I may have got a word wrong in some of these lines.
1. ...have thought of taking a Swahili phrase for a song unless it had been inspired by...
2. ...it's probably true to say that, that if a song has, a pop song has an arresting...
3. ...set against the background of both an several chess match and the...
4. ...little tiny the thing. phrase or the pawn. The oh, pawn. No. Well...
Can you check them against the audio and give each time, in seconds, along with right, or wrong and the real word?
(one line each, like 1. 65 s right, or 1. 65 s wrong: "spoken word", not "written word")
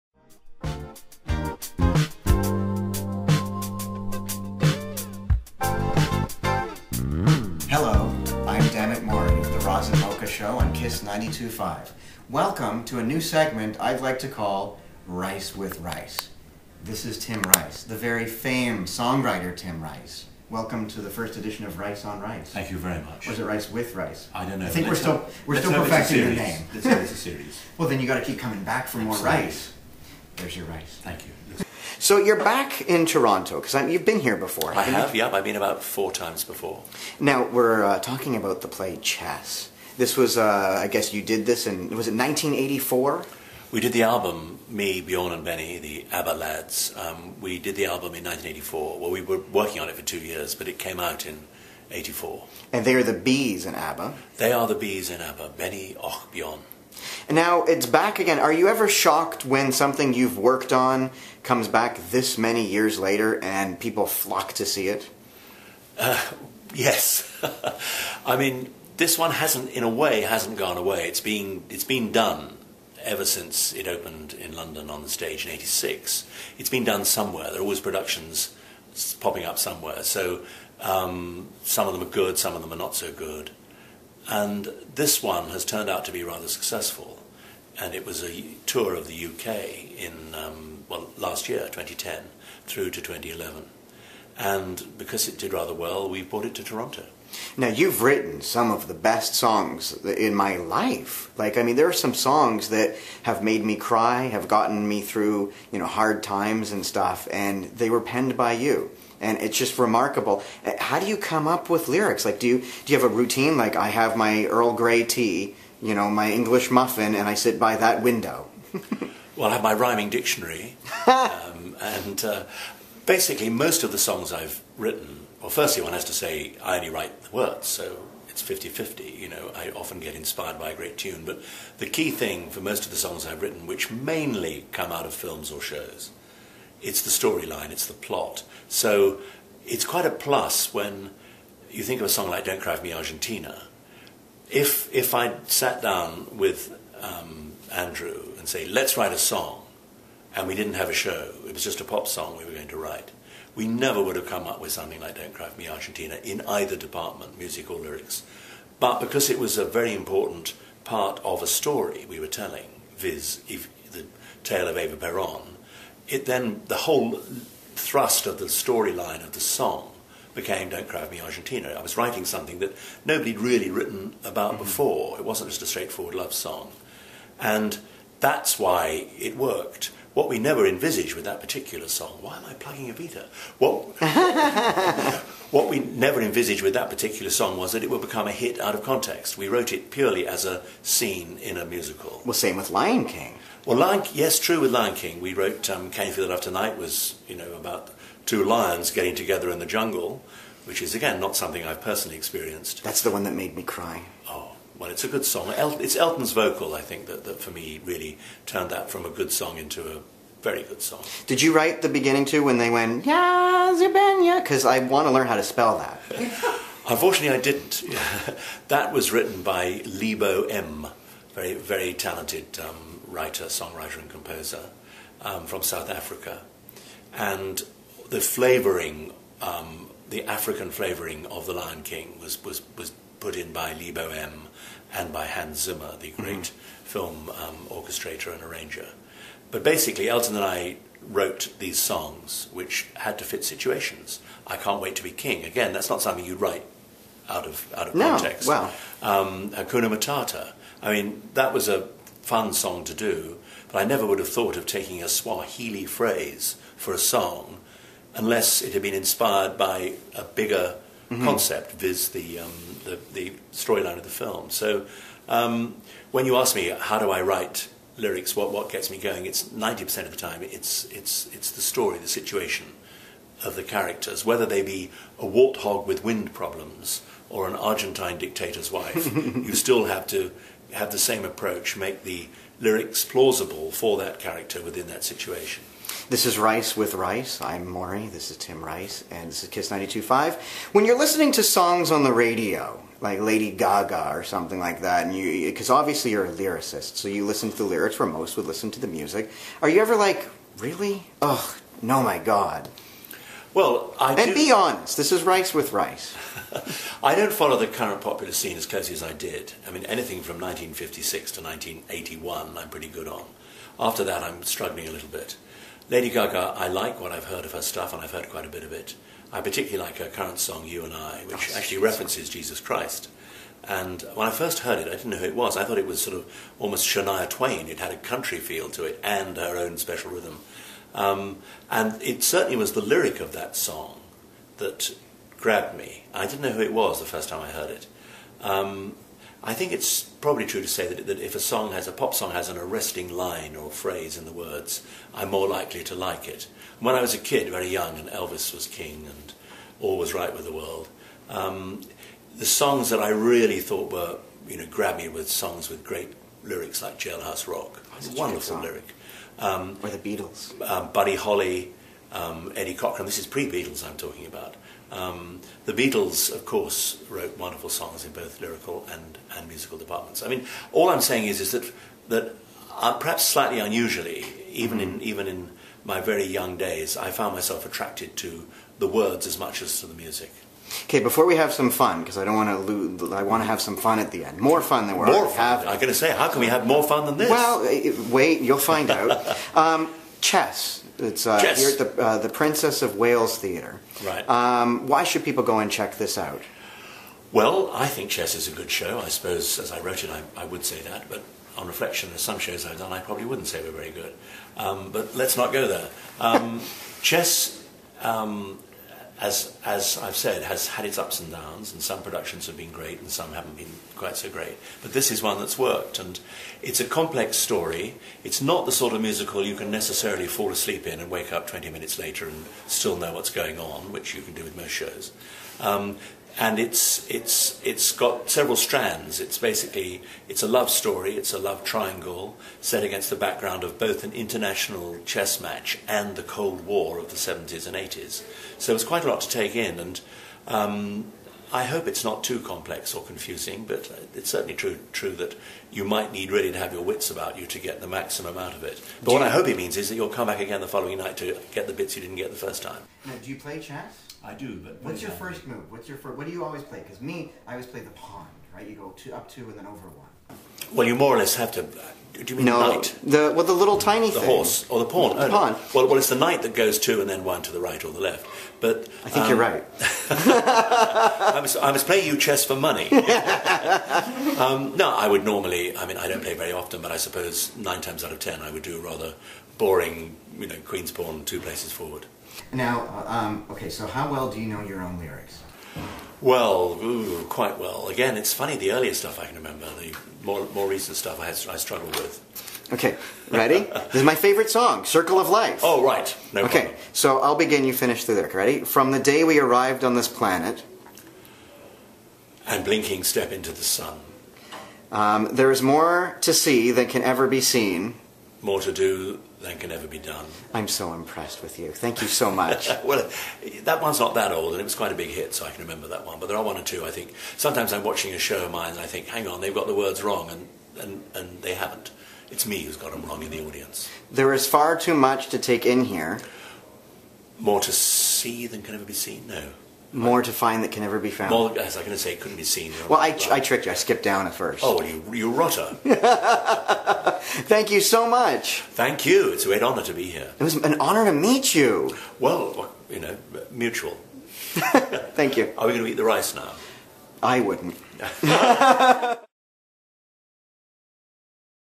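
1. 254 s right
2. 339 s right
3. 432 s wrong: "international", not "several"
4. 463 s wrong: "horse", not "phrase".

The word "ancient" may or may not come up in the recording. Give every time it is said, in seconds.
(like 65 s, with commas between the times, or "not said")
not said.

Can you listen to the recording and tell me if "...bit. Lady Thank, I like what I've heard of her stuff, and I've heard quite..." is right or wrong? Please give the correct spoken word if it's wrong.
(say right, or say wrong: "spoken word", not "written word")
wrong: "Gaga", not "Thank".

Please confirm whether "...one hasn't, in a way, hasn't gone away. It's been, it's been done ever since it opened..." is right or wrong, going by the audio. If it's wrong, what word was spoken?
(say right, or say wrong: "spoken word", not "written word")
right.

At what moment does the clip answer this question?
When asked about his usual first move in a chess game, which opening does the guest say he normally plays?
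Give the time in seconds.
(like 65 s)
480 s.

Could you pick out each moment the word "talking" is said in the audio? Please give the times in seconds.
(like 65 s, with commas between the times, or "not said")
37 s, 363 s.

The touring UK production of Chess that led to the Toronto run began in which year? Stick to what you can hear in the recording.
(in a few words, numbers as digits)
2010.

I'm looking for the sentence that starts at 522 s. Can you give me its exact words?
It's me who's got them wrong in the audience.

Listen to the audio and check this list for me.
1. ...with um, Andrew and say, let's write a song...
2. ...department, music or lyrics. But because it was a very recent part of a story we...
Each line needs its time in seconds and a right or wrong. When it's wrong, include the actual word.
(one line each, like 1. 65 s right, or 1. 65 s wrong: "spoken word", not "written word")
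1. 146 s right
2. 156 s wrong: "important", not "recent".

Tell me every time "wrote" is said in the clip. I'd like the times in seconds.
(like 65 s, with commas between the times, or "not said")
189 s, 195 s, 241 s, 367 s, 399 s.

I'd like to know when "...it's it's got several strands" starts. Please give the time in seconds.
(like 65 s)
427 s.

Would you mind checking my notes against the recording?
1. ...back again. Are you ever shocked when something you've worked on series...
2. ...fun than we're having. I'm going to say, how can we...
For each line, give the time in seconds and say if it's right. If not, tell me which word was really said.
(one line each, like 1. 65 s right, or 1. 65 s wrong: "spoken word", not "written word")
1. 57 s wrong: "comes", not "series"
2. 384 s right.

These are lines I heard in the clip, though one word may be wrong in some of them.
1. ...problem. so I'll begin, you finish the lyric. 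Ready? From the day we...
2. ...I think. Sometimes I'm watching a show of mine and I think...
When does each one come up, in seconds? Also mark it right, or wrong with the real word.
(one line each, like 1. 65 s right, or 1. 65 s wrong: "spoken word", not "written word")
1. 496 s right
2. 516 s right.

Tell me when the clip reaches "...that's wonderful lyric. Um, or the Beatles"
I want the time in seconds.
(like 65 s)
357 s.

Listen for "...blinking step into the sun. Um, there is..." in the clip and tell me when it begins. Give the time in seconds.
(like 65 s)
502 s.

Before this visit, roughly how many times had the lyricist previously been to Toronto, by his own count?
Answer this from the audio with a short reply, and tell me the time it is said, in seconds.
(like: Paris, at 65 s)
4, at 35 s.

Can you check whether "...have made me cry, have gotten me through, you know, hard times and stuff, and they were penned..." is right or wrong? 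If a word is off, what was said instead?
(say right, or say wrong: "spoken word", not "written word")
right.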